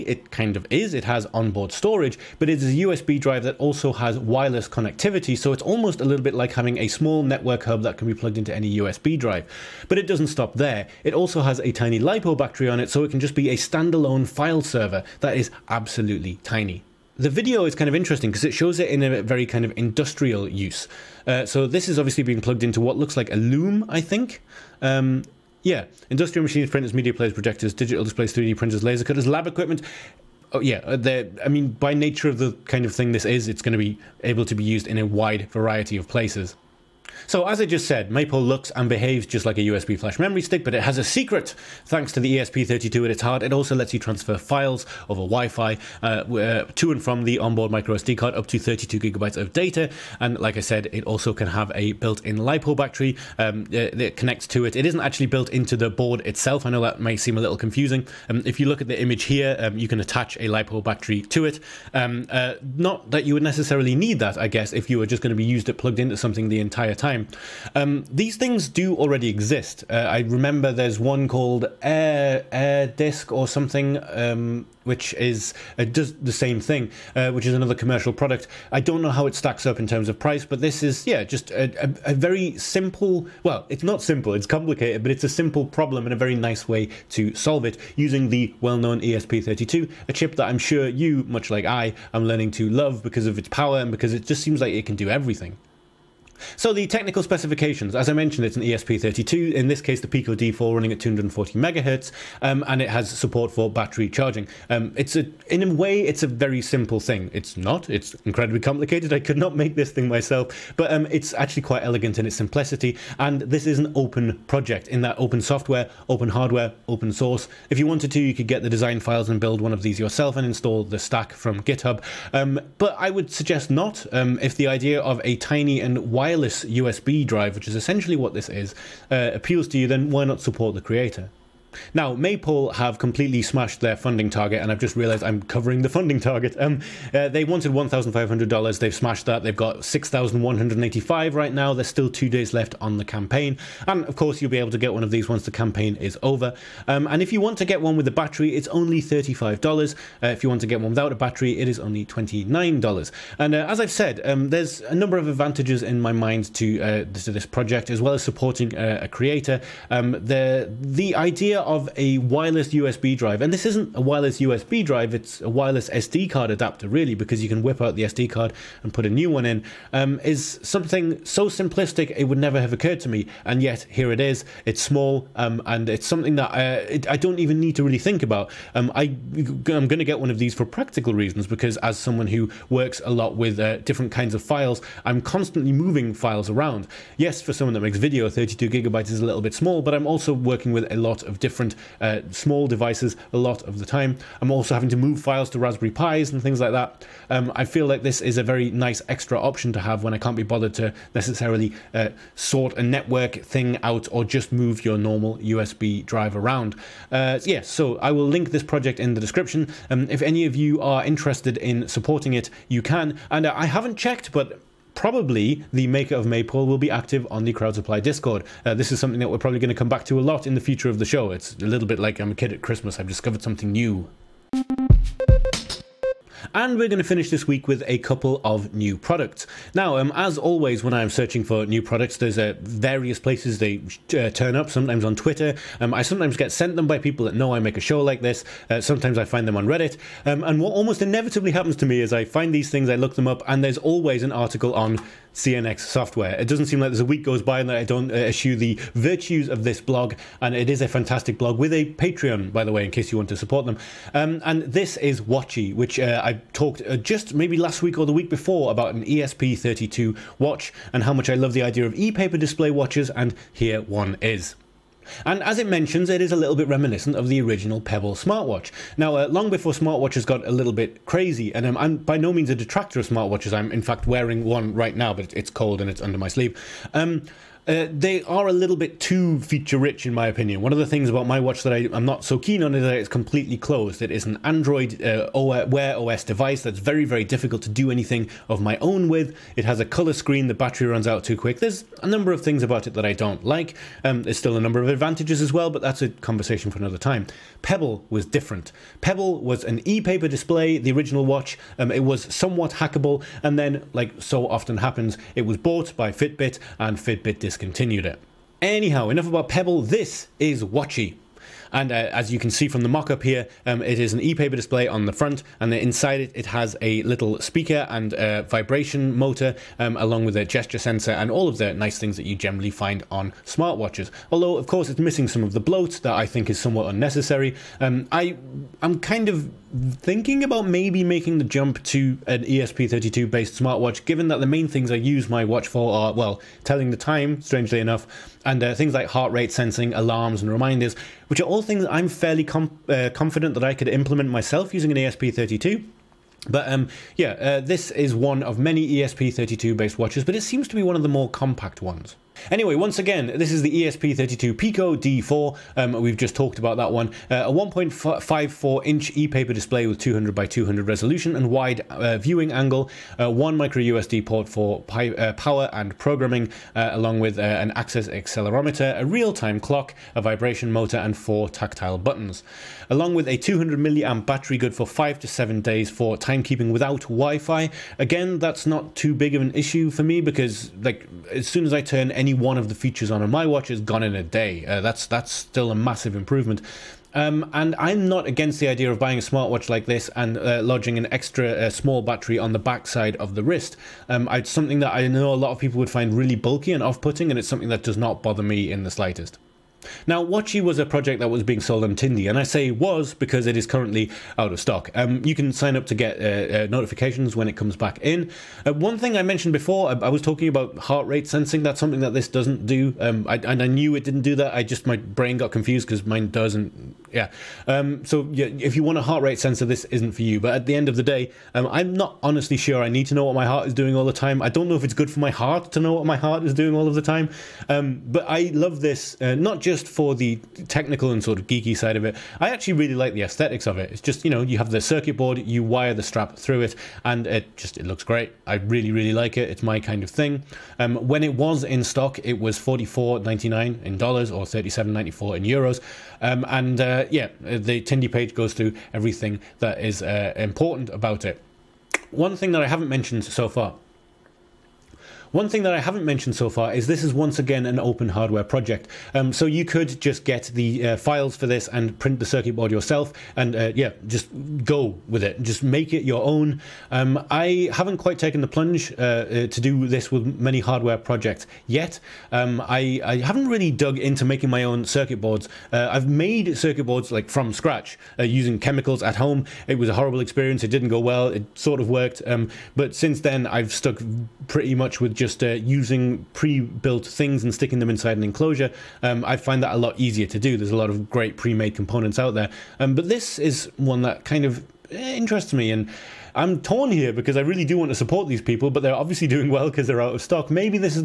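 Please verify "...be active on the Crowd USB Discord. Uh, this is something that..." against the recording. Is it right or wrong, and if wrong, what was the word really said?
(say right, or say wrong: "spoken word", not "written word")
wrong: "Supply", not "USB".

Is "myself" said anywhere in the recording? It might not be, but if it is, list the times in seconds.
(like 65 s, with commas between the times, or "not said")
110 s, 344 s.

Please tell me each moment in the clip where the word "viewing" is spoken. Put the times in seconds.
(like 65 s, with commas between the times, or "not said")
362 s.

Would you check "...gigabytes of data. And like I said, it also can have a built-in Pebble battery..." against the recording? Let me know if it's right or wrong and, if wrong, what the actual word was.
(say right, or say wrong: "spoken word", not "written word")
wrong: "LiPo", not "Pebble".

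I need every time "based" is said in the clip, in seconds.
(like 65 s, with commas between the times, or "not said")
333 s, 349 s.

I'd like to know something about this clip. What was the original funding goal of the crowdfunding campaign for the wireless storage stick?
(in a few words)
$1,500.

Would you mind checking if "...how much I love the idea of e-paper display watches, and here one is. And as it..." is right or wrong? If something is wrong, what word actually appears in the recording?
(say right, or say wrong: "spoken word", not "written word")
right.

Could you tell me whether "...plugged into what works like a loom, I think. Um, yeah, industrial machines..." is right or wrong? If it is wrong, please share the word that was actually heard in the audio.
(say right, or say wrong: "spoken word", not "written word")
wrong: "looks", not "works".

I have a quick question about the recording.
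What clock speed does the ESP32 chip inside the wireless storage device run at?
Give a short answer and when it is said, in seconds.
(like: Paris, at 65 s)
240 megahertz, at 101 s.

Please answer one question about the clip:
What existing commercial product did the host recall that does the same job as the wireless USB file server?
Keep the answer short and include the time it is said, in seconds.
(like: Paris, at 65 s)
Air Disk, at 72 s.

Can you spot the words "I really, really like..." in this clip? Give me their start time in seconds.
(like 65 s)
438 s.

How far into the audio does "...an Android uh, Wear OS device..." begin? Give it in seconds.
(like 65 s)
284 s.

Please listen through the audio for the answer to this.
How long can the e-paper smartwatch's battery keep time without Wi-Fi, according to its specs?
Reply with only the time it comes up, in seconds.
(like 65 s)
374 s.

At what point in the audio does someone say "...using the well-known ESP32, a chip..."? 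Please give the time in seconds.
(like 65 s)
87 s.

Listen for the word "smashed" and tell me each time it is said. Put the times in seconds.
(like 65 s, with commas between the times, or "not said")
133 s, 138 s.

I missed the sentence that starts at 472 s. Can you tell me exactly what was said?
Um, I, I, haven't really dug into making my own circuit boards.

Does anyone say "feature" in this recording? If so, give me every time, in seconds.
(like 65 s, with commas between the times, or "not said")
279 s, 382 s.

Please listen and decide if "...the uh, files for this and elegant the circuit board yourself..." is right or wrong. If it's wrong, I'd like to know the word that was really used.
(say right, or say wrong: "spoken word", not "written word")
wrong: "print", not "elegant".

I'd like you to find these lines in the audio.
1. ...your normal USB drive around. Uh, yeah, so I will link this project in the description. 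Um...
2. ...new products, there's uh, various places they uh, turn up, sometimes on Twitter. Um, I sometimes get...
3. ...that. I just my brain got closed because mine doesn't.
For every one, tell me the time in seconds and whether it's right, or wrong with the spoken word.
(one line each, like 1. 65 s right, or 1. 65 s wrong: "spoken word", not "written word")
1. 204 s right
2. 231 s right
3. 414 s wrong: "confused", not "closed".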